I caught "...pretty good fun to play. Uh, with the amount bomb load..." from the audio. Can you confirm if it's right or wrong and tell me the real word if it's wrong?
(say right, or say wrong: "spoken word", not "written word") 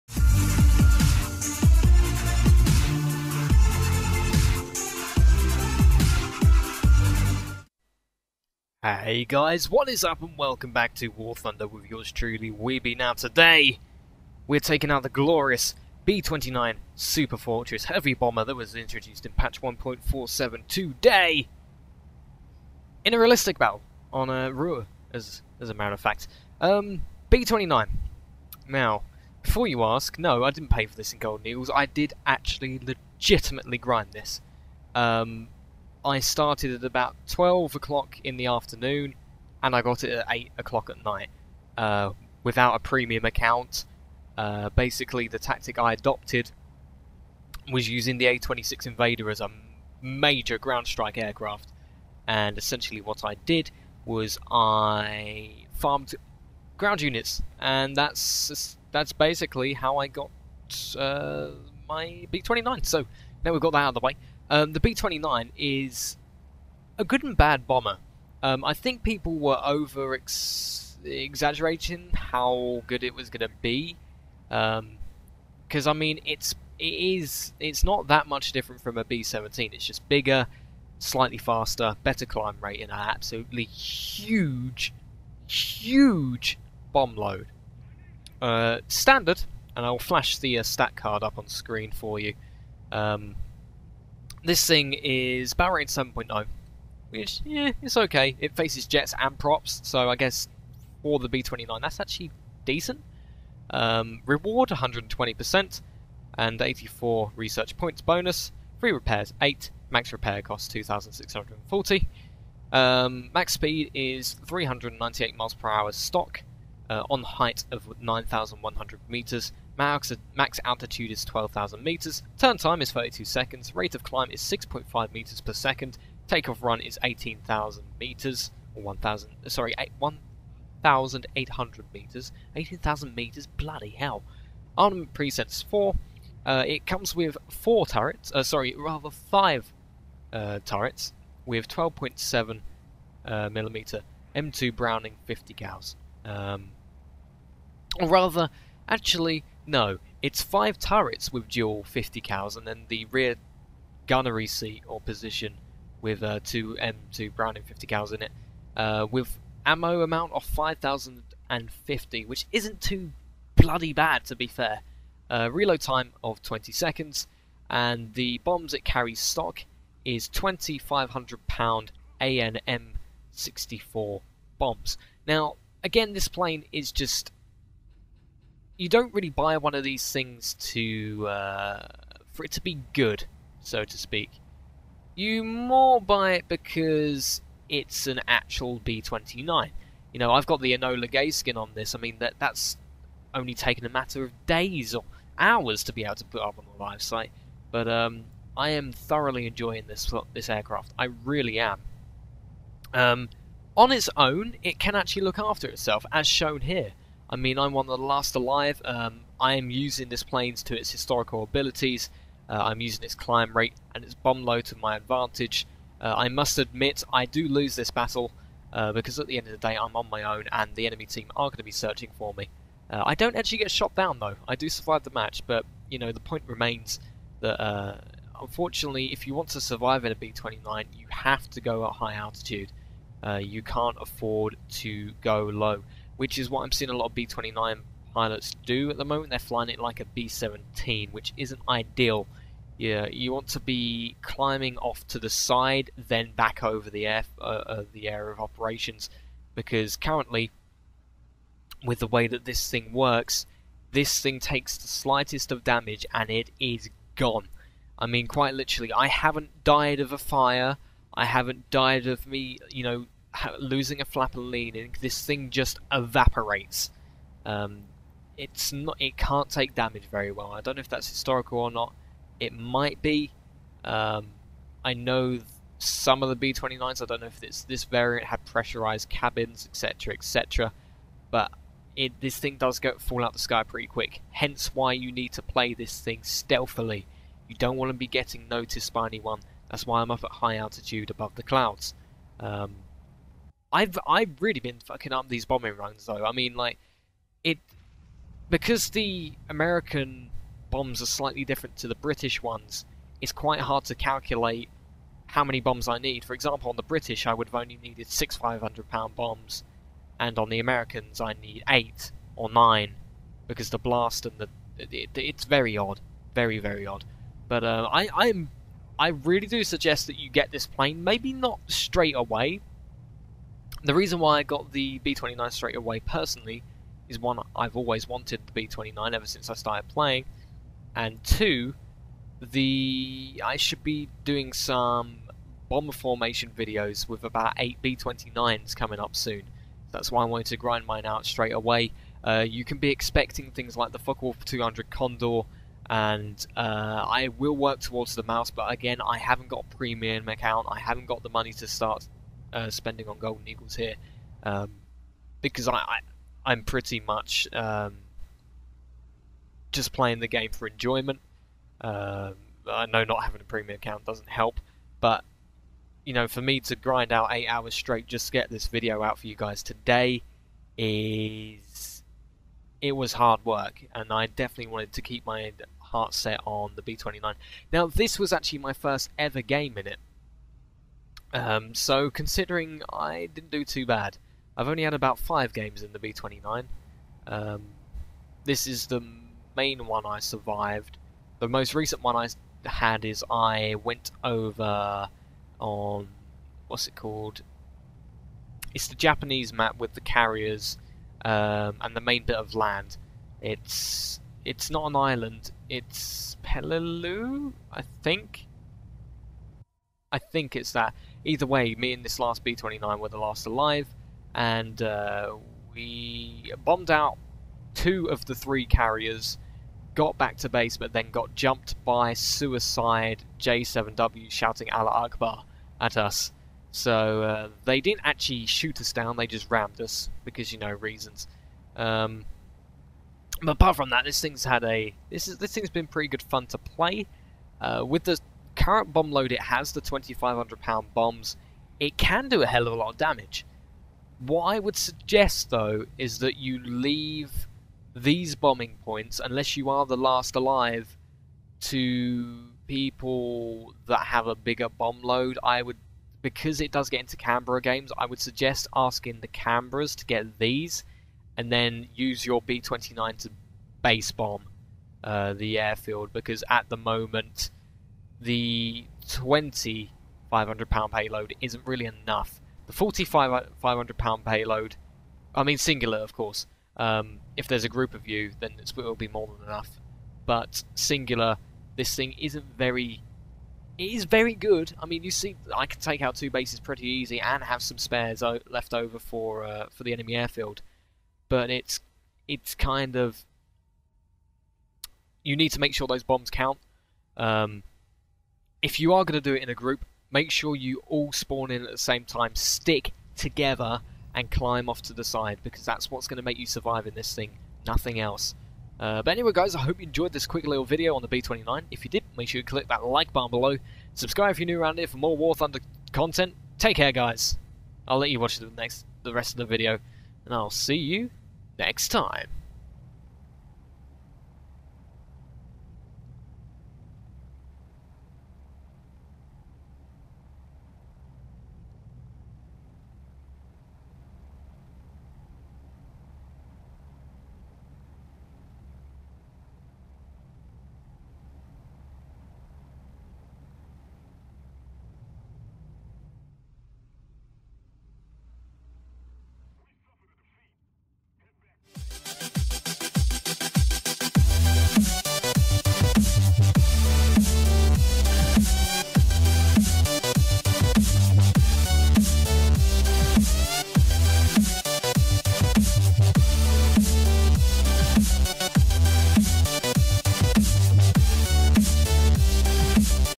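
wrong: "current", not "amount".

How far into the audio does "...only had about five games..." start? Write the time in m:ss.
6:24.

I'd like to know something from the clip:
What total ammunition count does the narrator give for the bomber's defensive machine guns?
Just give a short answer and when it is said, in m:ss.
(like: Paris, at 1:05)
5,050, at 2:40.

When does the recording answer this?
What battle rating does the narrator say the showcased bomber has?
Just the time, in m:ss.
1:36.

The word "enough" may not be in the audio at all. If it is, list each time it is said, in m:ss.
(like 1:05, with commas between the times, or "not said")
7:51, 7:59.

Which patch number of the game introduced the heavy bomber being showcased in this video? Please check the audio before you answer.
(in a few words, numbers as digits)
1.47.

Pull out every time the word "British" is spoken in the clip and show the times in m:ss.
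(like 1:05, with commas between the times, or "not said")
5:01, 5:06.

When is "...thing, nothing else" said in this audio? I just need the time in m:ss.
8:27.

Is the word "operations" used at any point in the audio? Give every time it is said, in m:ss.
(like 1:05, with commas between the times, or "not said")
4:08.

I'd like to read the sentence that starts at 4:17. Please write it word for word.
I mean, quite literally, I haven't died of a fire.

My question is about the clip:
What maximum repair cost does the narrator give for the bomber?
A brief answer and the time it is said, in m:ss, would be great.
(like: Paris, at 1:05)
2640, at 1:50.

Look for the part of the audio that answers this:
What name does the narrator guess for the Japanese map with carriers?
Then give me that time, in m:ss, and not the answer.
6:46.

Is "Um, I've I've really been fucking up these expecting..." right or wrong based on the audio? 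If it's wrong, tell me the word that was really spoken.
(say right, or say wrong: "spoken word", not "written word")
wrong: "bombing", not "expecting".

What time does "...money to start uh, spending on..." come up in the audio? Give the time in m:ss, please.
5:51.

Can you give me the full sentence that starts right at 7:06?
So uh, they didn't actually shoot us down, they just rammed us, because you know, reasons.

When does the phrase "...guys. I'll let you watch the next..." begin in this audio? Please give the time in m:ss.
8:36.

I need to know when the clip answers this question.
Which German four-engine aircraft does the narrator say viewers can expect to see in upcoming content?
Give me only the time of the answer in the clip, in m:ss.
5:43.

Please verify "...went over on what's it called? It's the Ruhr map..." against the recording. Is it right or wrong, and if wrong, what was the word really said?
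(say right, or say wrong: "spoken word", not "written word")
wrong: "Japanese", not "Ruhr".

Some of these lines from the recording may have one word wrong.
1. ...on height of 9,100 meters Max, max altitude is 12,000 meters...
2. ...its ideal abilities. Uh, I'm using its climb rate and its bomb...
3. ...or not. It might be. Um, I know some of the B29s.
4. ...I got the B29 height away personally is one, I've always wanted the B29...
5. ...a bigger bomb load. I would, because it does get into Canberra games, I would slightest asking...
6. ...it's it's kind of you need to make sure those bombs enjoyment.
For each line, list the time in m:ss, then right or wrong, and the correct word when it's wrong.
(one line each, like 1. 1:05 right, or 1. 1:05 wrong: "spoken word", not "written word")
1. 1:57 right
2. 3:30 wrong: "historical", not "ideal"
3. 4:31 right
4. 5:24 wrong: "straight", not "height"
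5. 7:34 wrong: "suggest", not "slightest"
6. 8:11 wrong: "count", not "enjoyment".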